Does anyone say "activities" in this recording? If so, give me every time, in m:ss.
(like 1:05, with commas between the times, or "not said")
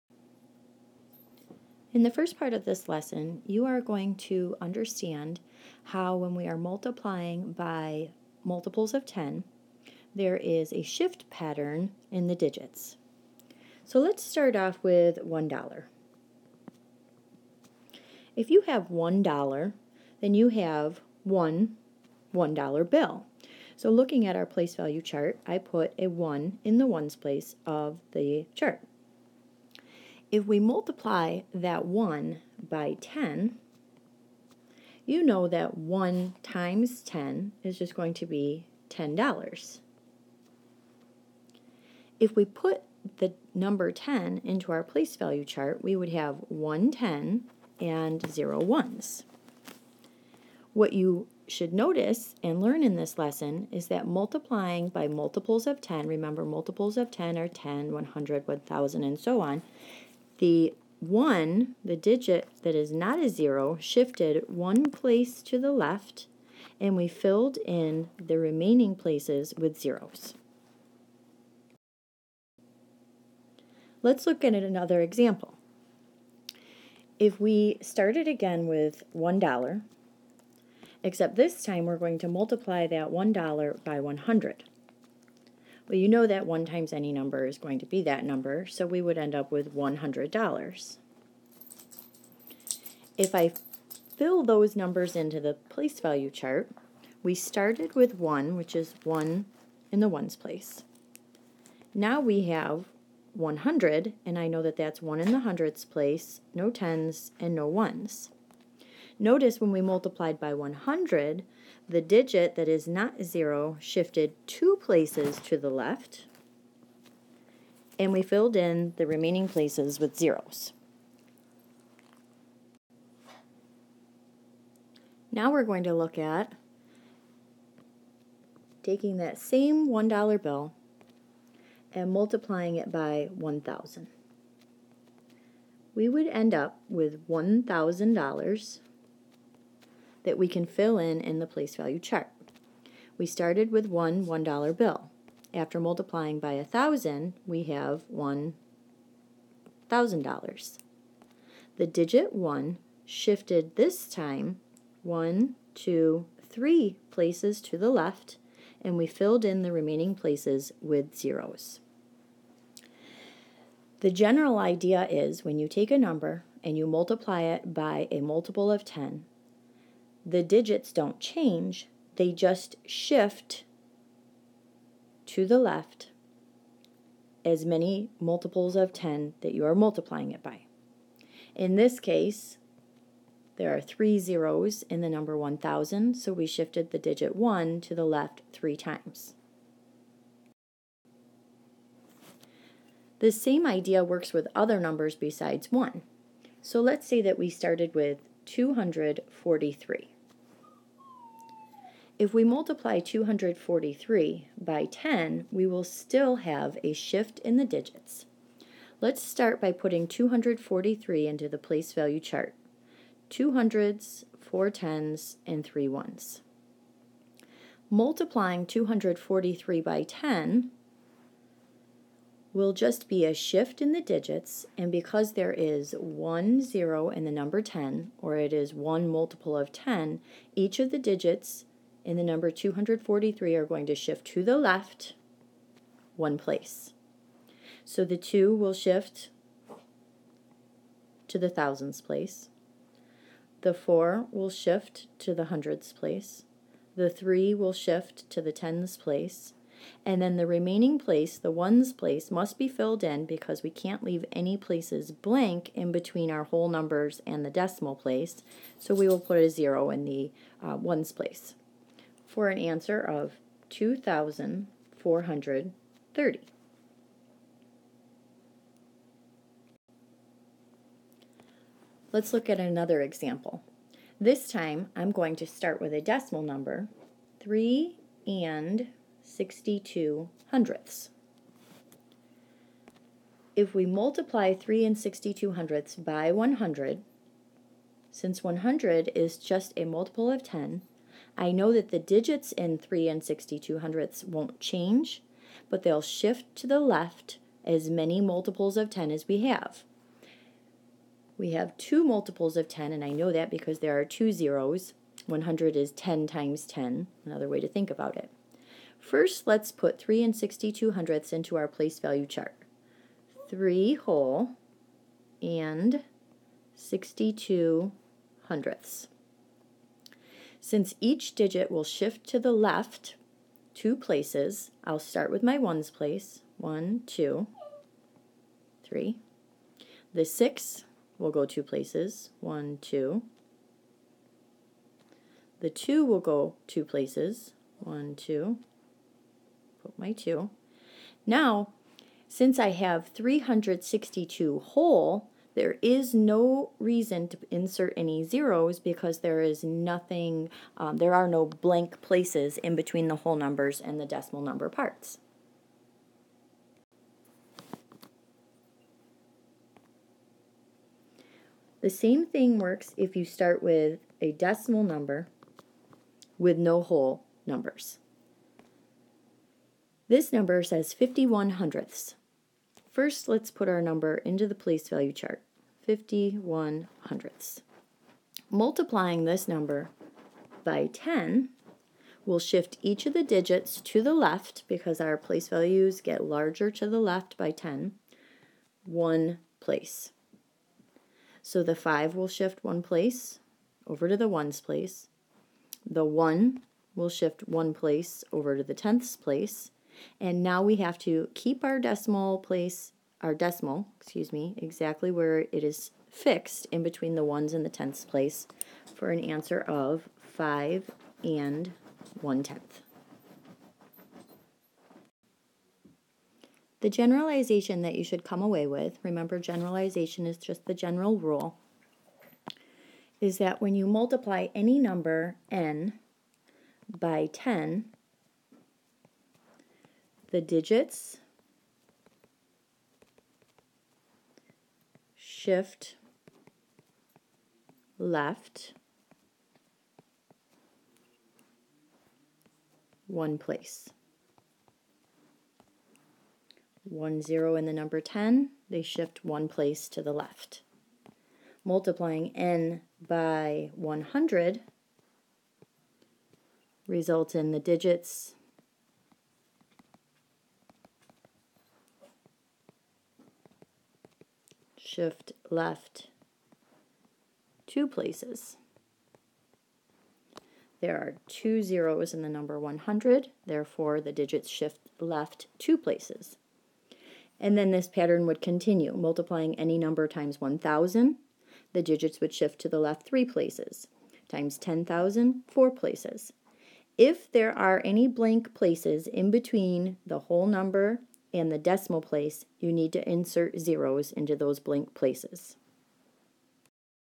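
not said.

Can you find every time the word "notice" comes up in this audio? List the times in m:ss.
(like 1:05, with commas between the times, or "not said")
0:51, 1:49.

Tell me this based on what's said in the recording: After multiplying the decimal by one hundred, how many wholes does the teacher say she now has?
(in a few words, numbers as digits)
362.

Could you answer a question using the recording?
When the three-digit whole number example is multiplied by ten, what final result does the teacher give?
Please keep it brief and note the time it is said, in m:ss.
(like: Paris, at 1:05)
2,430, at 4:23.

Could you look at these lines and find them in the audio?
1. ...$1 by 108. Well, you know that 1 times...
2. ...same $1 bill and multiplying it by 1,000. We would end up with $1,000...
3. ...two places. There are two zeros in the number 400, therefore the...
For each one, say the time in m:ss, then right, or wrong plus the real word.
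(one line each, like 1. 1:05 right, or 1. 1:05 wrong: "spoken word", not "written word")
1. 1:23 wrong: "100", not "108"
2. 2:09 right
3. 7:47 wrong: "100", not "400".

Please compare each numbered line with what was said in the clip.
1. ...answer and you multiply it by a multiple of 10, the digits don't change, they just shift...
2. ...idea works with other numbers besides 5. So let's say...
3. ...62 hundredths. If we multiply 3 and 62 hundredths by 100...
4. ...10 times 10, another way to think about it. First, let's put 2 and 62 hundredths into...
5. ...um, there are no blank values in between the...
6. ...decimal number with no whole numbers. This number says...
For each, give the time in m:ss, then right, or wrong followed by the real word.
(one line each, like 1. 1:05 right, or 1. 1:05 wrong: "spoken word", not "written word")
1. 2:45 wrong: "number", not "answer"
2. 3:13 wrong: "1", not "5"
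3. 4:39 right
4. 5:05 wrong: "3", not "2"
5. 5:50 wrong: "places", not "values"
6. 6:04 right.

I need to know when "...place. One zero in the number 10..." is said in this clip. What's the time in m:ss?
7:23.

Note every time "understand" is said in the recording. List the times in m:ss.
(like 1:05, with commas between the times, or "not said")
0:04.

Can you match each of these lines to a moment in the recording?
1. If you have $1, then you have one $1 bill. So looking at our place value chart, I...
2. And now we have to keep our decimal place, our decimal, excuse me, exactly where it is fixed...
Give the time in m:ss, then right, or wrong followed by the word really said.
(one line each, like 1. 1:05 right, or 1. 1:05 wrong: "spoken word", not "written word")
1. 0:18 right
2. 6:40 right.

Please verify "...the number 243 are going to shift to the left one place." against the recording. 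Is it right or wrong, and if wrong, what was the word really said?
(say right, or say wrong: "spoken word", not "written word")
right.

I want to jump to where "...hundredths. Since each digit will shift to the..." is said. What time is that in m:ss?
5:18.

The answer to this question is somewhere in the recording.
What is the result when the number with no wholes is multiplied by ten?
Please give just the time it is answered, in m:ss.
6:50.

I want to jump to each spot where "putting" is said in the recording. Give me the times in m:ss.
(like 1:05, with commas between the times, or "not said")
3:29.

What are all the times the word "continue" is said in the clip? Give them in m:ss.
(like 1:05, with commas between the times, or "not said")
7:58.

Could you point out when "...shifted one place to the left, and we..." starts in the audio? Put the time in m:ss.
1:03.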